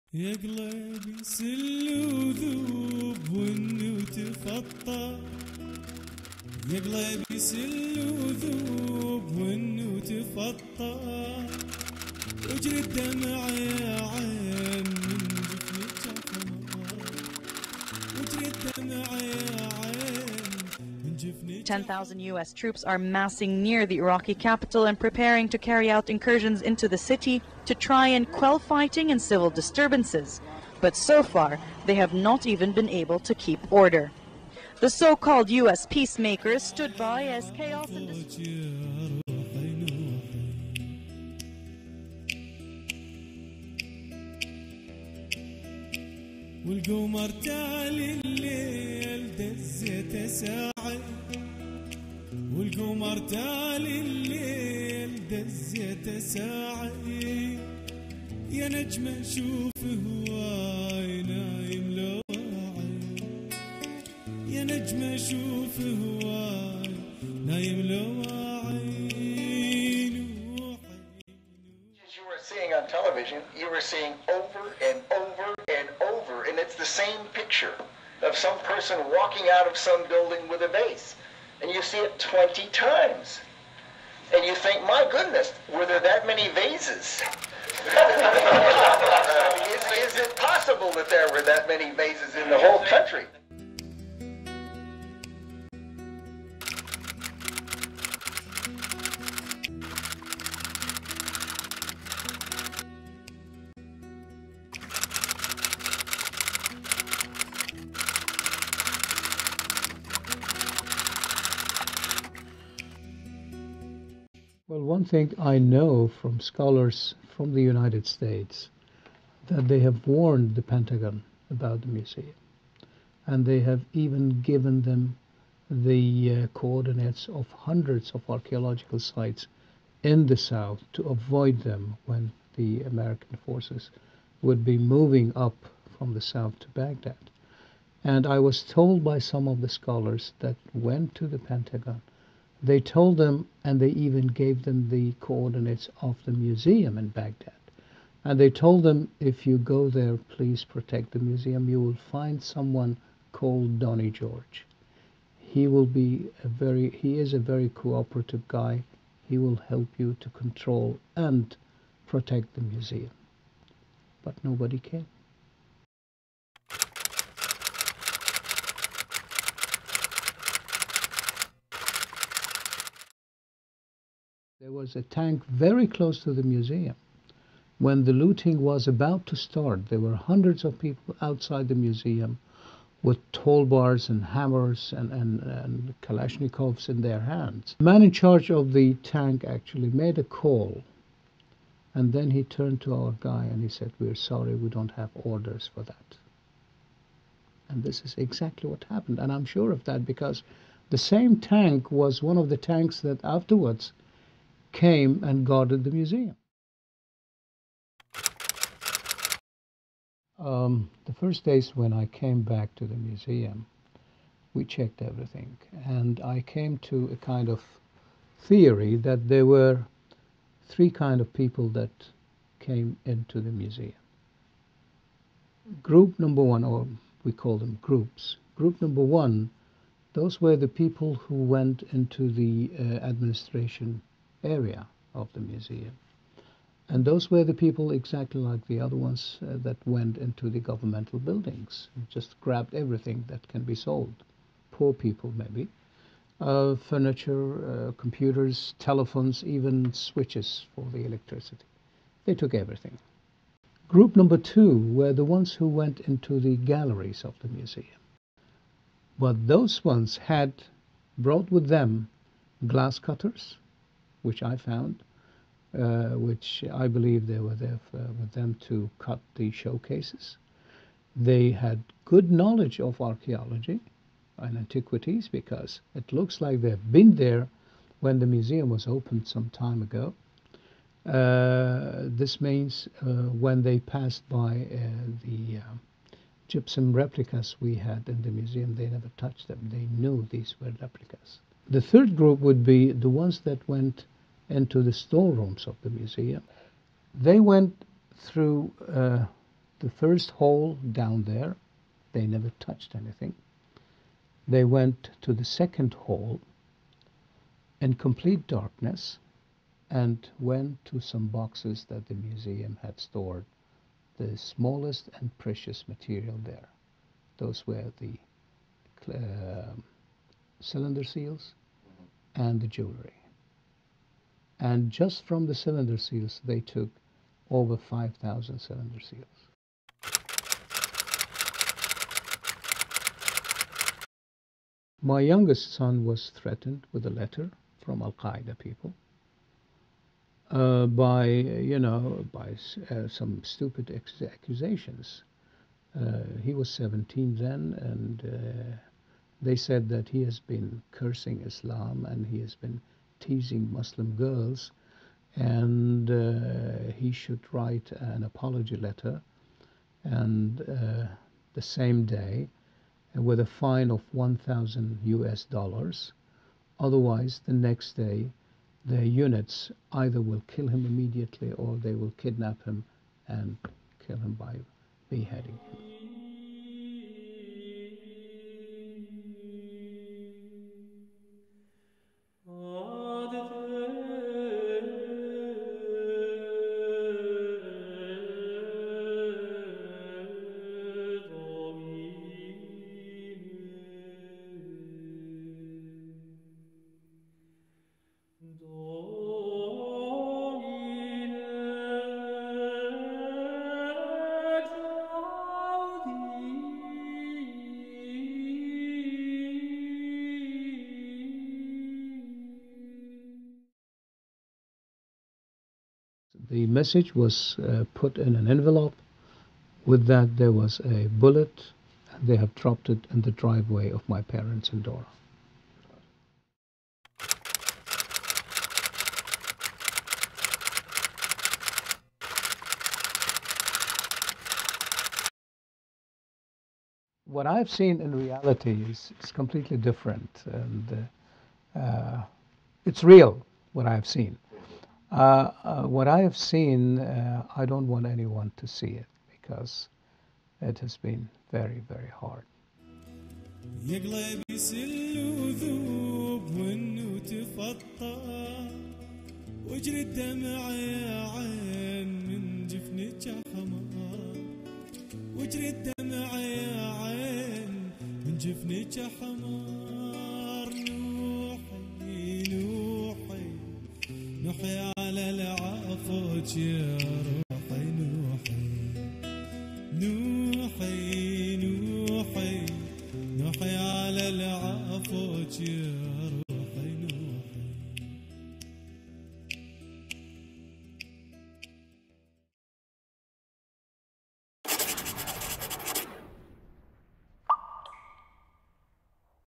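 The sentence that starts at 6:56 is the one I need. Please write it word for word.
the message was uh, put in an envelope.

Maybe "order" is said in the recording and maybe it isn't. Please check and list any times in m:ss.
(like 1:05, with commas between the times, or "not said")
0:33, 3:15.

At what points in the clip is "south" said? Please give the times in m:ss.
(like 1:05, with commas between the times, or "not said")
2:10, 2:16.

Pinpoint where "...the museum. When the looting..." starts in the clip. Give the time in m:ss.
2:56.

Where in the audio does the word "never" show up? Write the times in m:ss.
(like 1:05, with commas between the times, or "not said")
4:48, 5:02.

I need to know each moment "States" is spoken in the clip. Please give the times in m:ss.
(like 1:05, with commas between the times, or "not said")
1:58.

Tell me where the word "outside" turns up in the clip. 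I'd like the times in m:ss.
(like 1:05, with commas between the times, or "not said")
3:01.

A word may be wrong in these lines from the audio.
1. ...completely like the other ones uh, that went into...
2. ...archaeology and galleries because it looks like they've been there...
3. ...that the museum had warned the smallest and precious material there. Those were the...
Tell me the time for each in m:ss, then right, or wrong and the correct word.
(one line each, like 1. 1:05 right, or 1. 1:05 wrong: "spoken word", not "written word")
1. 3:57 wrong: "exactly", not "completely"
2. 4:33 wrong: "antiquities", not "galleries"
3. 5:11 wrong: "stored", not "warned".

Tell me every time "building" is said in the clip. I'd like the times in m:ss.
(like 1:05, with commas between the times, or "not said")
1:20, 4:01.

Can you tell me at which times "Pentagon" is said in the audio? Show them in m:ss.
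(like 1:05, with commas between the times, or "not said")
2:00, 2:21.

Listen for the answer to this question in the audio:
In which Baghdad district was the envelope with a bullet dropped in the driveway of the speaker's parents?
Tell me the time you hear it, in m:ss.
7:04.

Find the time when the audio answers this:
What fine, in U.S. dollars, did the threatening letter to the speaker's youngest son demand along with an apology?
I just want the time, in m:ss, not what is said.
6:04.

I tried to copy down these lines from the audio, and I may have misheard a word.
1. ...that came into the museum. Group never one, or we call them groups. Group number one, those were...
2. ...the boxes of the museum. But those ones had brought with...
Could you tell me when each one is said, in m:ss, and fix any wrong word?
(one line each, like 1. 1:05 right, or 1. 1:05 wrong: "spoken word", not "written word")
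1. 3:41 wrong: "number", not "never"
2. 4:16 wrong: "galleries", not "boxes".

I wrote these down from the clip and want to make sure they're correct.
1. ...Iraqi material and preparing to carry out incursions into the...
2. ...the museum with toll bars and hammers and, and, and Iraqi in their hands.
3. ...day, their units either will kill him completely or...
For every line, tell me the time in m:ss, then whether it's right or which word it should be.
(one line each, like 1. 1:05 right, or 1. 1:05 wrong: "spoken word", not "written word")
1. 0:23 wrong: "capital", not "material"
2. 3:01 wrong: "Kalashnikovs", not "Iraqi"
3. 6:07 wrong: "immediately", not "completely".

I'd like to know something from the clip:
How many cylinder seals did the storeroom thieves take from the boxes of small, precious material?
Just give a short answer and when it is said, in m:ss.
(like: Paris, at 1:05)
over 5,000, at 5:27.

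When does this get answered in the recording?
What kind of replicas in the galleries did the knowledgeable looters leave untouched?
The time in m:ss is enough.
4:46.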